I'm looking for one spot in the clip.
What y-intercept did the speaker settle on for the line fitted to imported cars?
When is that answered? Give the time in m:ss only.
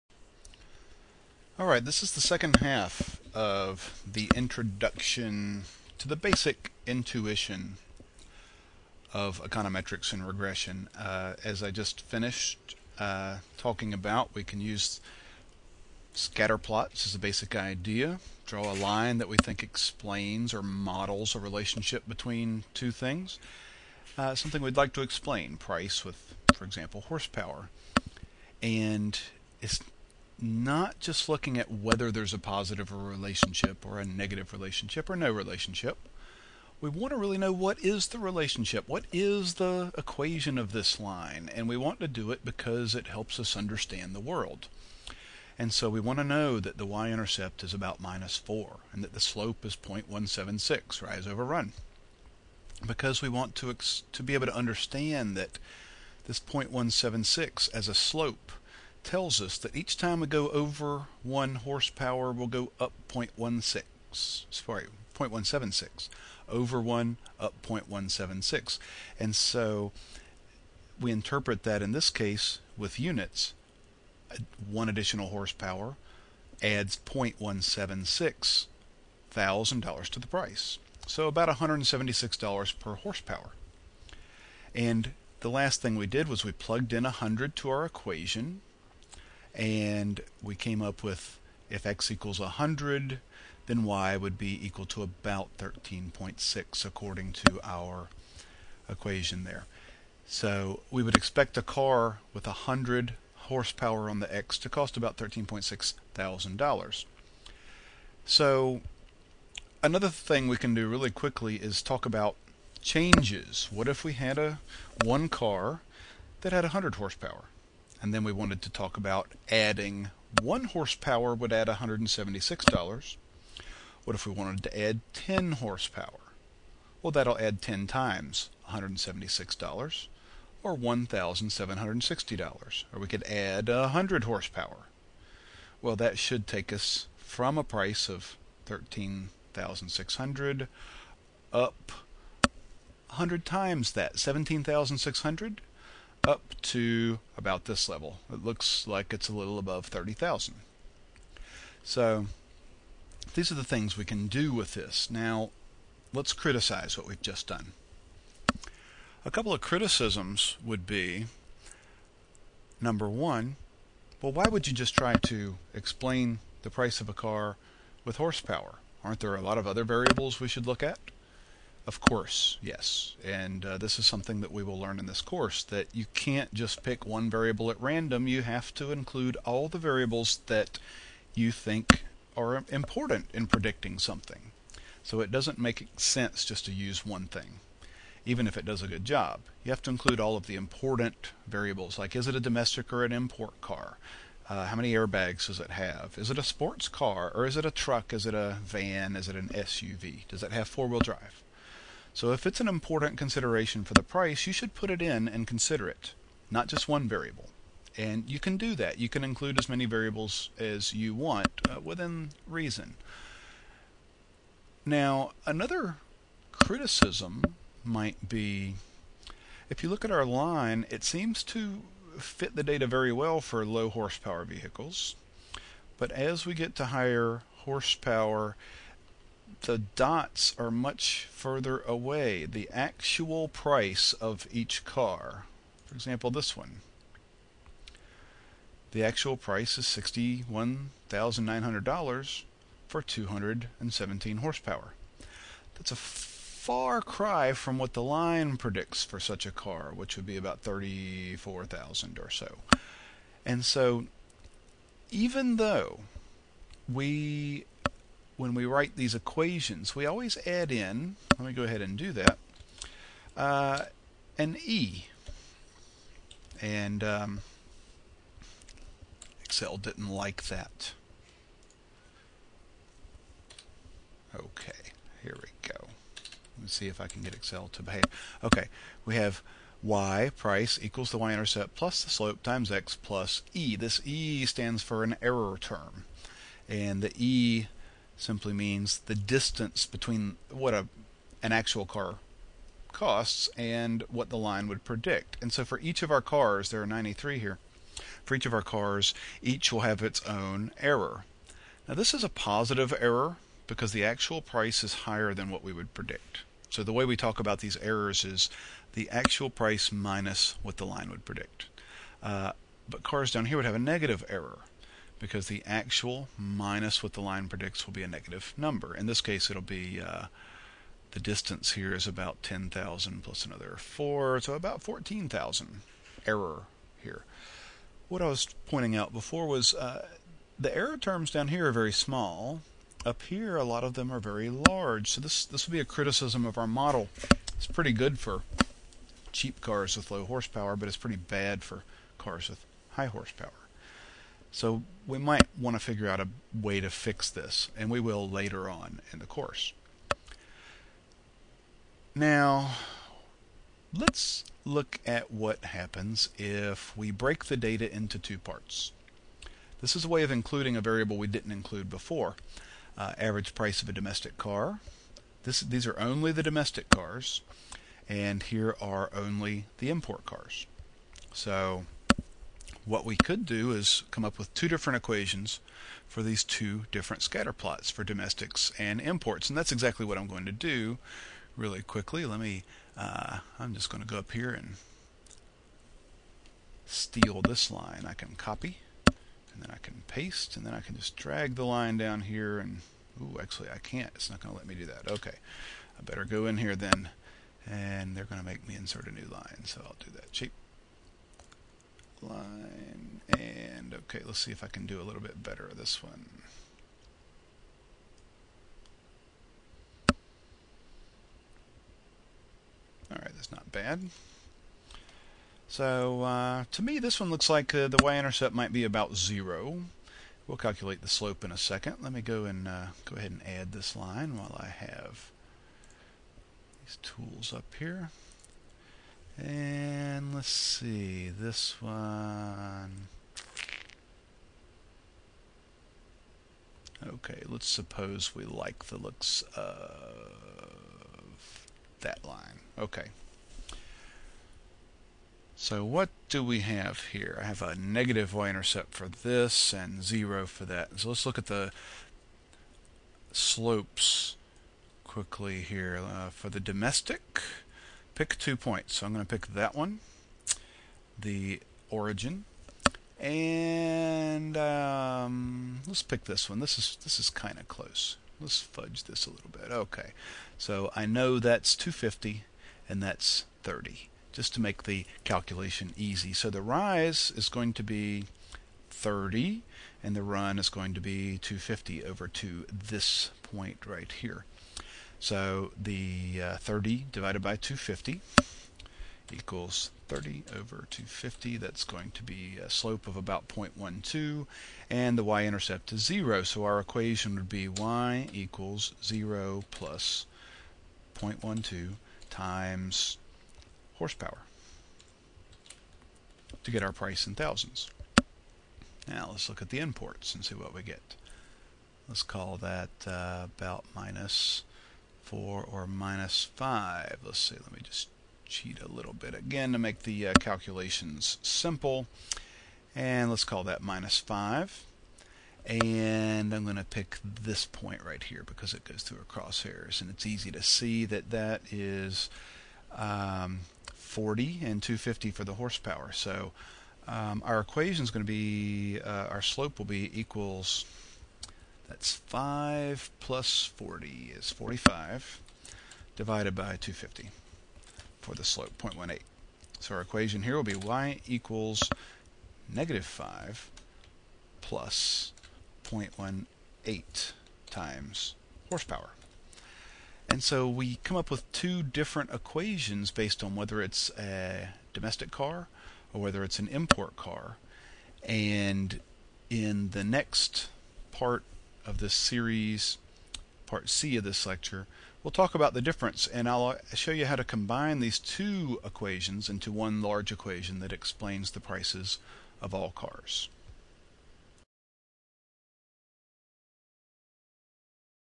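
8:43.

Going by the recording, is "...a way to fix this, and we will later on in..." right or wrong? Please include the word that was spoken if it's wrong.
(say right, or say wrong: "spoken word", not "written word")
right.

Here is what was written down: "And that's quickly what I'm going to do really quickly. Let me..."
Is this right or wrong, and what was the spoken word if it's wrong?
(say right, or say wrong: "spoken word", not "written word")
wrong: "exactly", not "quickly".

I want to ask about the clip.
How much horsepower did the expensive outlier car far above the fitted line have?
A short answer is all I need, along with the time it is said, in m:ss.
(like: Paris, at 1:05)
217, at 4:03.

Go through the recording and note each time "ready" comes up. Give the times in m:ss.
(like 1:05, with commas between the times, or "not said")
not said.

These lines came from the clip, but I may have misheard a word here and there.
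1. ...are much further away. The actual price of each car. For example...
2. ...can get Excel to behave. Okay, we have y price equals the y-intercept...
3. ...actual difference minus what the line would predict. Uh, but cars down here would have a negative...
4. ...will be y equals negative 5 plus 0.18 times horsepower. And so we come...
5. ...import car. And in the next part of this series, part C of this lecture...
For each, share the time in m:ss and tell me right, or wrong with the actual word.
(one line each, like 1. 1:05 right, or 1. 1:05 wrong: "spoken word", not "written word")
1. 3:50 right
2. 4:37 right
3. 5:09 wrong: "price", not "difference"
4. 9:10 right
5. 9:26 right.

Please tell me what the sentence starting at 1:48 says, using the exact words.
So another thing we can do really quickly is talk about changes.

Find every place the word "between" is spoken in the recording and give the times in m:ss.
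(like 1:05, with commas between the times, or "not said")
0:22, 4:49.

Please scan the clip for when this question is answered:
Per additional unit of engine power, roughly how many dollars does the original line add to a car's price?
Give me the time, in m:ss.
1:21.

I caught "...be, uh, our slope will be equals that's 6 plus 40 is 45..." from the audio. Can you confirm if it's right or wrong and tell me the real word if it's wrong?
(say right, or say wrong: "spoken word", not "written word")
wrong: "5", not "6".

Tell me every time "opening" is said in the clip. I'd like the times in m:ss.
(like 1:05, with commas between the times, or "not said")
not said.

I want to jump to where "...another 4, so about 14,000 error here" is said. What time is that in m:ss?
5:23.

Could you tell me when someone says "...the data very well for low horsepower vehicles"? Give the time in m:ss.
3:42.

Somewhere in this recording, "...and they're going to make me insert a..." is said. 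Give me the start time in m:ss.
6:37.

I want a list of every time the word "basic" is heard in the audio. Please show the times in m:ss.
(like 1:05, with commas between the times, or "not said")
0:06, 0:17.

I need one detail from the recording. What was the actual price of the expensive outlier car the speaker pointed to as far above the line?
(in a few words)
$61,900.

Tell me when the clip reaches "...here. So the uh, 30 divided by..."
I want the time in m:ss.
8:04.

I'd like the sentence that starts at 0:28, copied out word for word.
And it's not just looking at whether there's a positive relationship or a negative relationship or no relationship.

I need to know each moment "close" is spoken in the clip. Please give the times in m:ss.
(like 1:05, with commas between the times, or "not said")
7:47.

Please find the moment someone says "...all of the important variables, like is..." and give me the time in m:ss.
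3:10.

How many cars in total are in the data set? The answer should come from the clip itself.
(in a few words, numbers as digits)
93.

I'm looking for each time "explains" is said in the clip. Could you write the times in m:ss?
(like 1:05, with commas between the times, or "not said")
0:19, 0:25, 2:45, 9:40.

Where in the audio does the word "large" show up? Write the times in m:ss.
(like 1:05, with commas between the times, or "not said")
5:34, 9:40.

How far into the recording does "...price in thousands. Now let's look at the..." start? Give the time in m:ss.
8:26.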